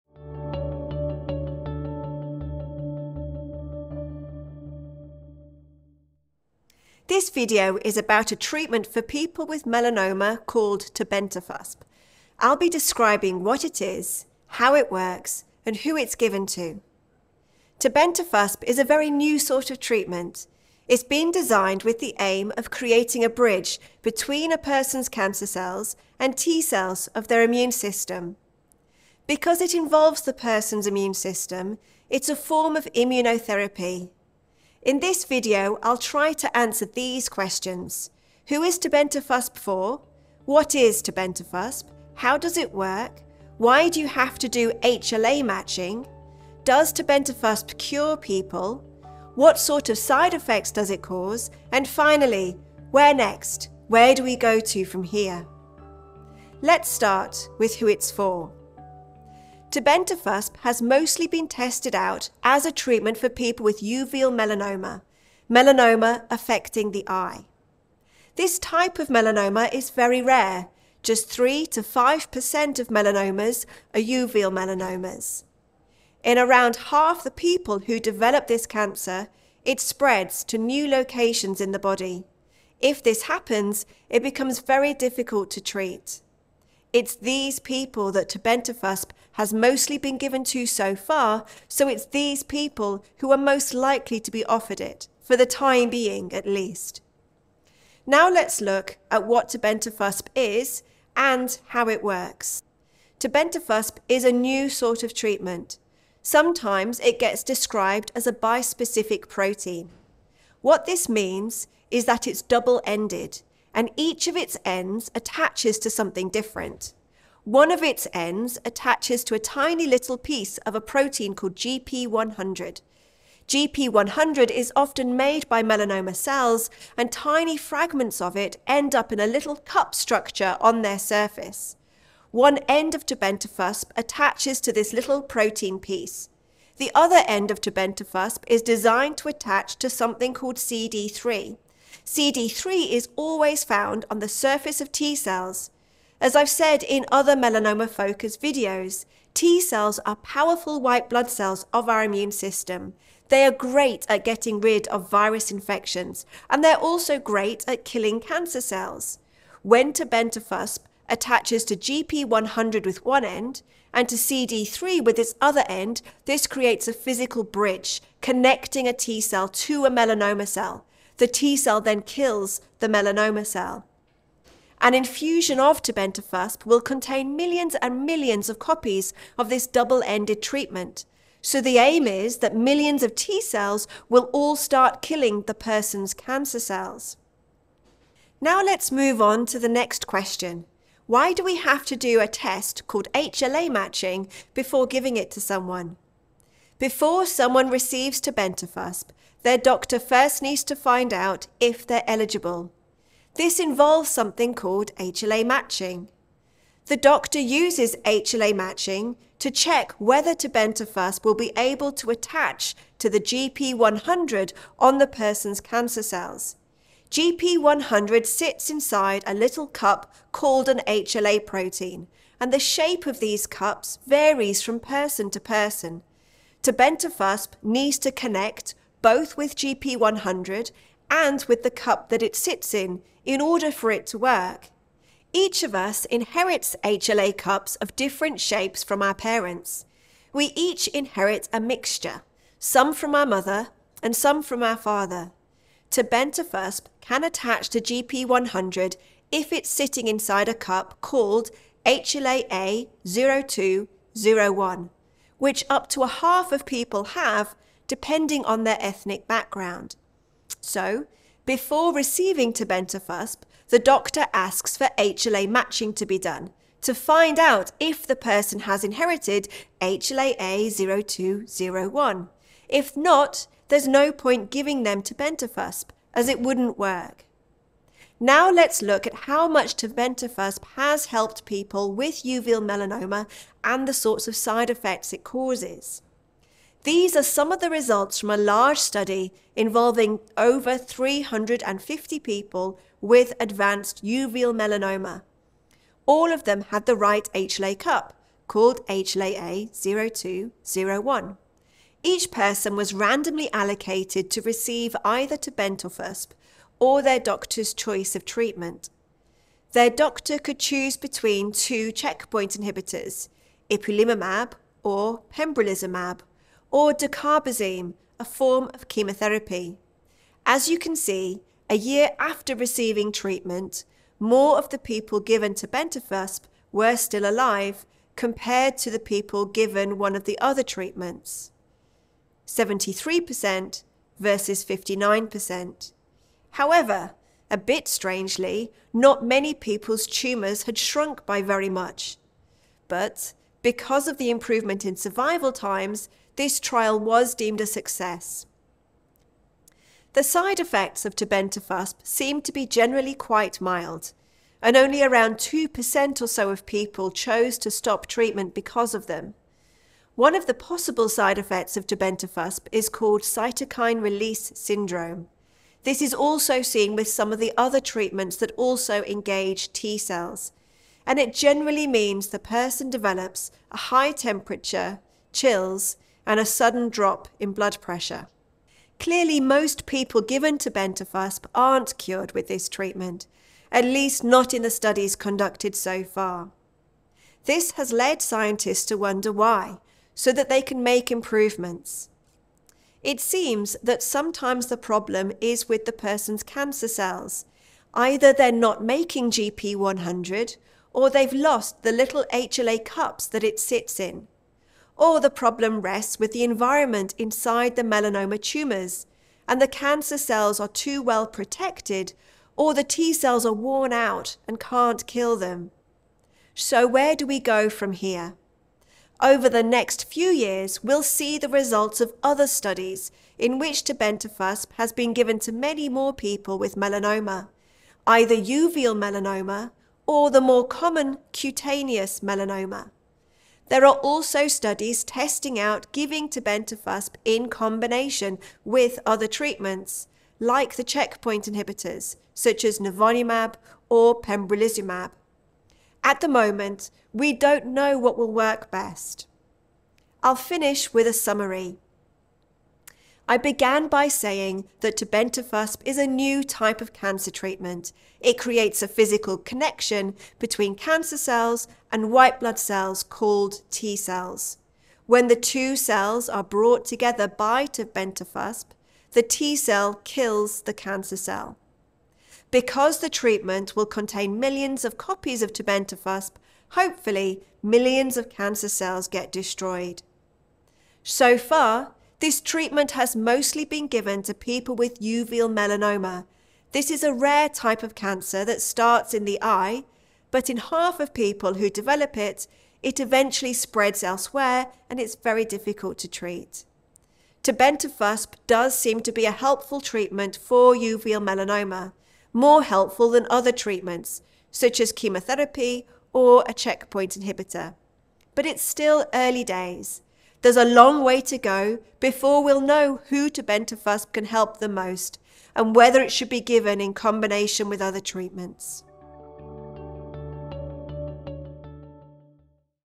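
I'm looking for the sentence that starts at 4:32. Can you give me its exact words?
If not, there's no point giving them tebentafusp, as it wouldn't work.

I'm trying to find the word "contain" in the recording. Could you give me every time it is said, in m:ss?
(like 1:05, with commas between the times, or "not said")
2:56, 7:53.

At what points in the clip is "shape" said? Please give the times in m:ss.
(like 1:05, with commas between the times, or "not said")
3:42, 3:58.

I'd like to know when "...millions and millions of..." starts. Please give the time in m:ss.
2:57.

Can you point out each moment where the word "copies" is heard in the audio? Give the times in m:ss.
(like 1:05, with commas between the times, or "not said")
2:58, 7:54.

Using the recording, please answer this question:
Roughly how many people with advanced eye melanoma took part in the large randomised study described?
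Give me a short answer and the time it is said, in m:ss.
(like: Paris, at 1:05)
over 350, at 4:50.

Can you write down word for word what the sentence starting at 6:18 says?
Clearly, most people given tebentafusp aren't cured with this treatment, at least not in the studies conducted so far.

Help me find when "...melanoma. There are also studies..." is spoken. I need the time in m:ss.
7:12.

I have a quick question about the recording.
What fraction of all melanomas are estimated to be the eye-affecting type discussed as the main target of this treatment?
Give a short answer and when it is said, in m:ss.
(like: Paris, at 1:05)
3 to 5%, at 1:11.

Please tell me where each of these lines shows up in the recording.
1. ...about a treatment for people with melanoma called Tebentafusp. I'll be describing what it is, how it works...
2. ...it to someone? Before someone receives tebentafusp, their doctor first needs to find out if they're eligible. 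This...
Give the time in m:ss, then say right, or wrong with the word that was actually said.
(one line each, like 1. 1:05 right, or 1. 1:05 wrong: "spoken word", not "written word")
1. 0:07 right
2. 3:15 right.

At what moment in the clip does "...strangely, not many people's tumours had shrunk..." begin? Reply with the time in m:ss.
5:37.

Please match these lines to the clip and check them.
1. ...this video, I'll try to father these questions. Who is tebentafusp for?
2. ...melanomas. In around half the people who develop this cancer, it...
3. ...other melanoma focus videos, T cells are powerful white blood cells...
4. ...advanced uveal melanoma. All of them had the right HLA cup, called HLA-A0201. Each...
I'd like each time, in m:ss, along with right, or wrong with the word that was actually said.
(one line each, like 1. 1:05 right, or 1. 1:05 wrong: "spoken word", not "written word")
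1. 0:34 wrong: "answer", not "father"
2. 1:14 right
3. 2:27 right
4. 4:53 right.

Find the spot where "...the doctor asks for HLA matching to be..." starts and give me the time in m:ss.
4:23.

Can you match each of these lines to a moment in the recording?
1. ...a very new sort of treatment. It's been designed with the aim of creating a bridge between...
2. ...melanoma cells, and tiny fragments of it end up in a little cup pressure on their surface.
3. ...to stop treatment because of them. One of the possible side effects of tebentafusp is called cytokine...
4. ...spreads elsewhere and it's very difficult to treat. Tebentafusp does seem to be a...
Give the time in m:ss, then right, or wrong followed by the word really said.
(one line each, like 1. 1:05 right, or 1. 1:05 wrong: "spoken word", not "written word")
1. 0:18 right
2. 2:05 wrong: "structure", not "pressure"
3. 5:57 right
4. 8:13 right.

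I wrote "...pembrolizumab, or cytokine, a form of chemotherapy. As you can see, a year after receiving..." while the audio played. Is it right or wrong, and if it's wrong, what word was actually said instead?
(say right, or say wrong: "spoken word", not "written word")
wrong: "dacarbazine", not "cytokine".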